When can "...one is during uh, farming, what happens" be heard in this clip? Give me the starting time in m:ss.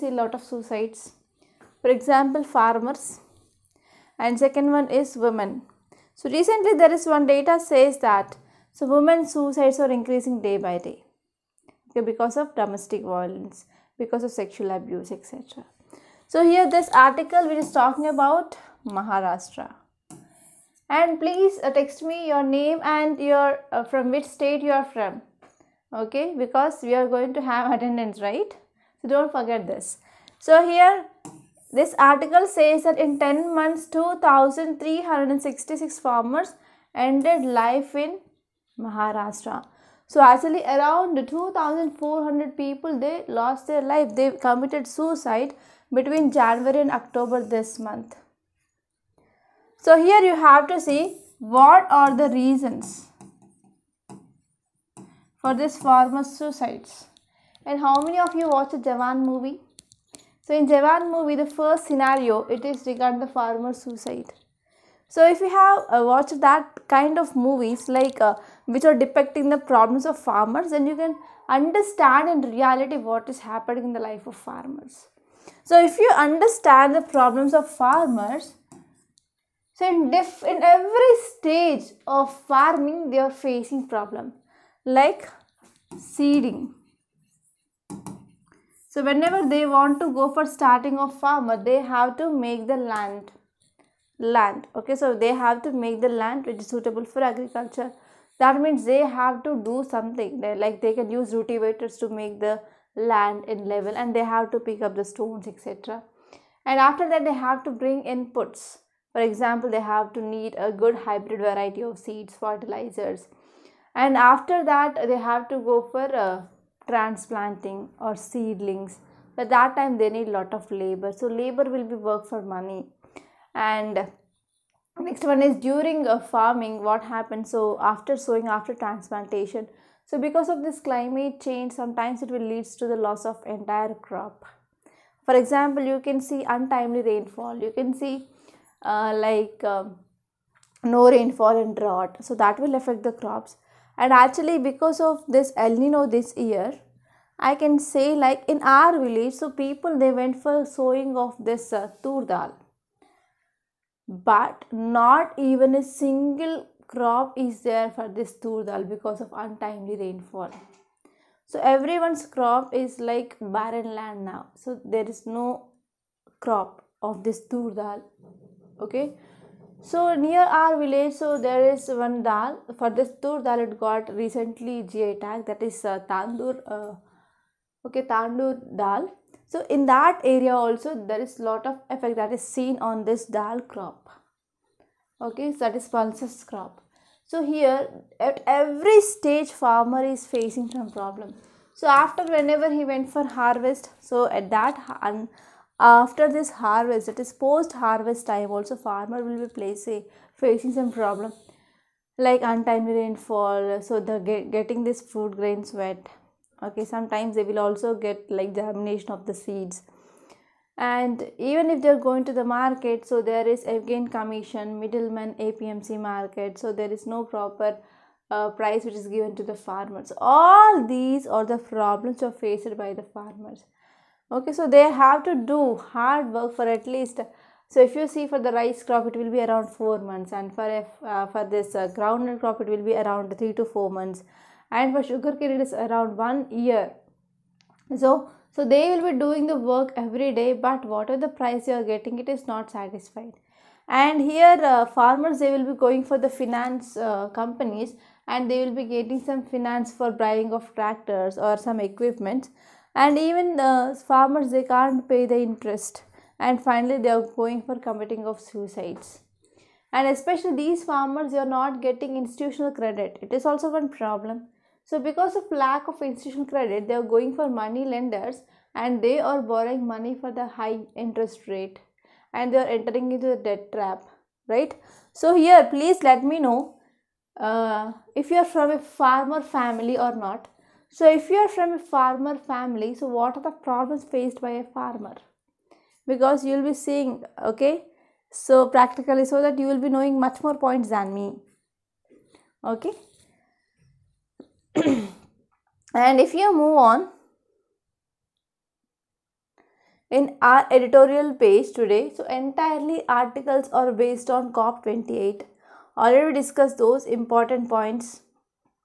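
2:05.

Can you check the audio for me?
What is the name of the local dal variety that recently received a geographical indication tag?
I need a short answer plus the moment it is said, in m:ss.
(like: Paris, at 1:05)
Tandur dal, at 2:56.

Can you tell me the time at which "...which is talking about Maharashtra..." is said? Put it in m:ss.
0:17.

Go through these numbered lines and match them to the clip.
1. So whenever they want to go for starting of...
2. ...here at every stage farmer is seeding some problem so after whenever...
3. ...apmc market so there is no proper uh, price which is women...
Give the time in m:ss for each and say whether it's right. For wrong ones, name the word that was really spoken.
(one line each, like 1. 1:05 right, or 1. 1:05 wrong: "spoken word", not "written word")
1. 1:28 right
2. 3:07 wrong: "facing", not "seeding"
3. 3:35 wrong: "given", not "women".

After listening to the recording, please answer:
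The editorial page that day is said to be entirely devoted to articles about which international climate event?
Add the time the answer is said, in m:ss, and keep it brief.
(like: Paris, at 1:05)
COP28, at 5:04.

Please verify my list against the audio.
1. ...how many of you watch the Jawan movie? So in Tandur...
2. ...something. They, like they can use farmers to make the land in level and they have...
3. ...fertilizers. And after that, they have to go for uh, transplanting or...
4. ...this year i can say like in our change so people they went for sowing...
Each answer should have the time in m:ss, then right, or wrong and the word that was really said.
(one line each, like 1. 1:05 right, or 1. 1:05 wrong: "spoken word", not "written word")
1. 0:57 wrong: "Jawan", not "Tandur"
2. 1:39 wrong: "rotivators", not "farmers"
3. 1:52 right
4. 2:26 wrong: "village", not "change".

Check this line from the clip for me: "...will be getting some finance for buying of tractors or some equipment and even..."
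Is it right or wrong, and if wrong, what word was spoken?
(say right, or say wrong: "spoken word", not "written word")
right.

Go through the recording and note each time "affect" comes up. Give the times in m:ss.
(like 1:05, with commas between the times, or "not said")
2:22.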